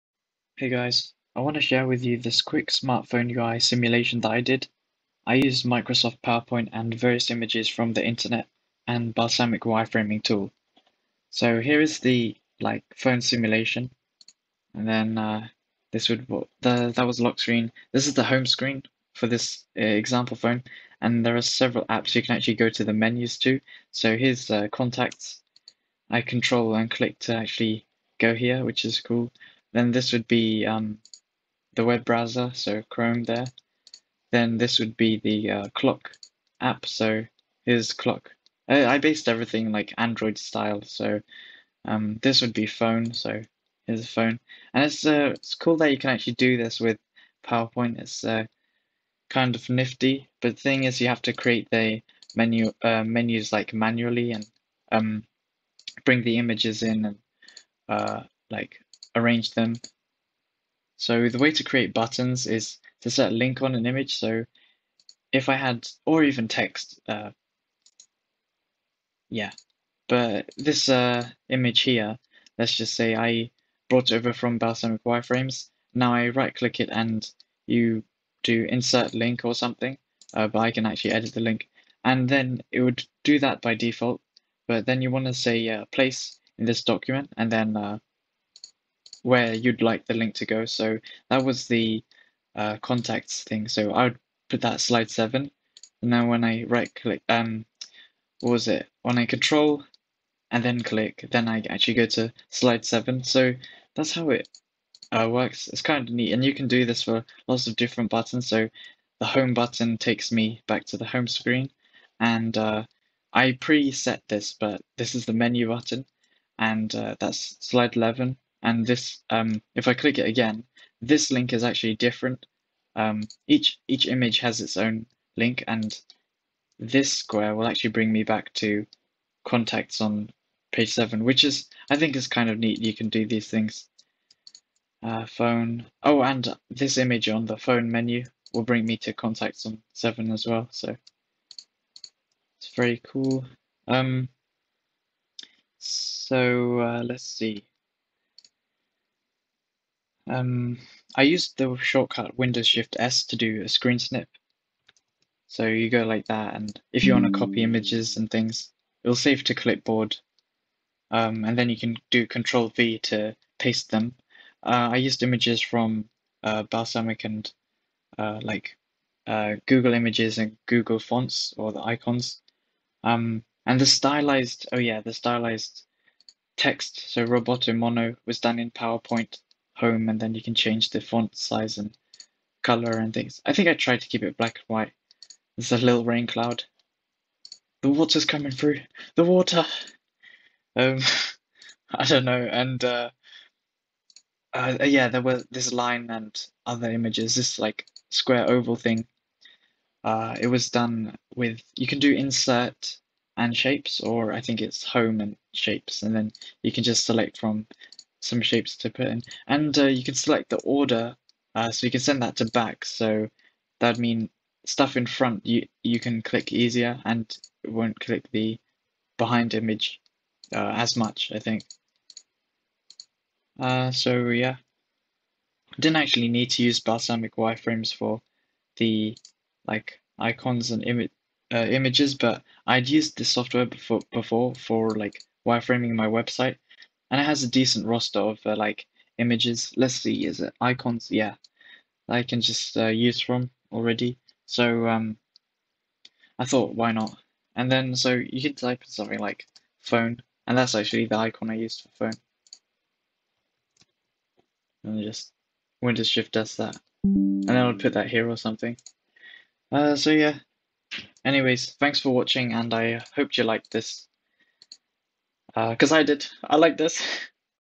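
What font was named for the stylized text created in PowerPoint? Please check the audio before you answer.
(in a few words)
Roboto Mono.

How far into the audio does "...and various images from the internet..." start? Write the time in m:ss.
0:06.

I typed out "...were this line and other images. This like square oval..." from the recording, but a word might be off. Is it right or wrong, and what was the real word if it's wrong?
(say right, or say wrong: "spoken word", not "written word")
right.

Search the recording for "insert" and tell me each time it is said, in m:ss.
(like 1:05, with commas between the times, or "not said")
1:18, 3:22.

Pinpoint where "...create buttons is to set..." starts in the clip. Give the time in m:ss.
1:01.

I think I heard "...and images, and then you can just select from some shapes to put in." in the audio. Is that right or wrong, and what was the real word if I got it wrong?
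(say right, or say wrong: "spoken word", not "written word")
wrong: "shapes", not "images".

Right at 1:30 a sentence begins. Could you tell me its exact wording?
So that was the uh, contacts thing.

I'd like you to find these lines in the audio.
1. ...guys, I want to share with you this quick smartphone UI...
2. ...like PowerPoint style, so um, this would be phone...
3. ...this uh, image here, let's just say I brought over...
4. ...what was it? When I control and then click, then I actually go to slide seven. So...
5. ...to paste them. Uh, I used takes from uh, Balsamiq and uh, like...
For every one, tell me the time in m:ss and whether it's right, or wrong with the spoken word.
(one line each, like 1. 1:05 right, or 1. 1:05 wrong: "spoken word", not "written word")
1. 0:00 right
2. 0:39 wrong: "Android", not "PowerPoint"
3. 1:10 right
4. 1:38 right
5. 2:42 wrong: "images", not "takes".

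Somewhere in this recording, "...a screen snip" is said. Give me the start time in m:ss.
2:33.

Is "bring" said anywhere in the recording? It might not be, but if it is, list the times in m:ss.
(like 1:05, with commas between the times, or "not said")
0:56, 2:07, 2:18.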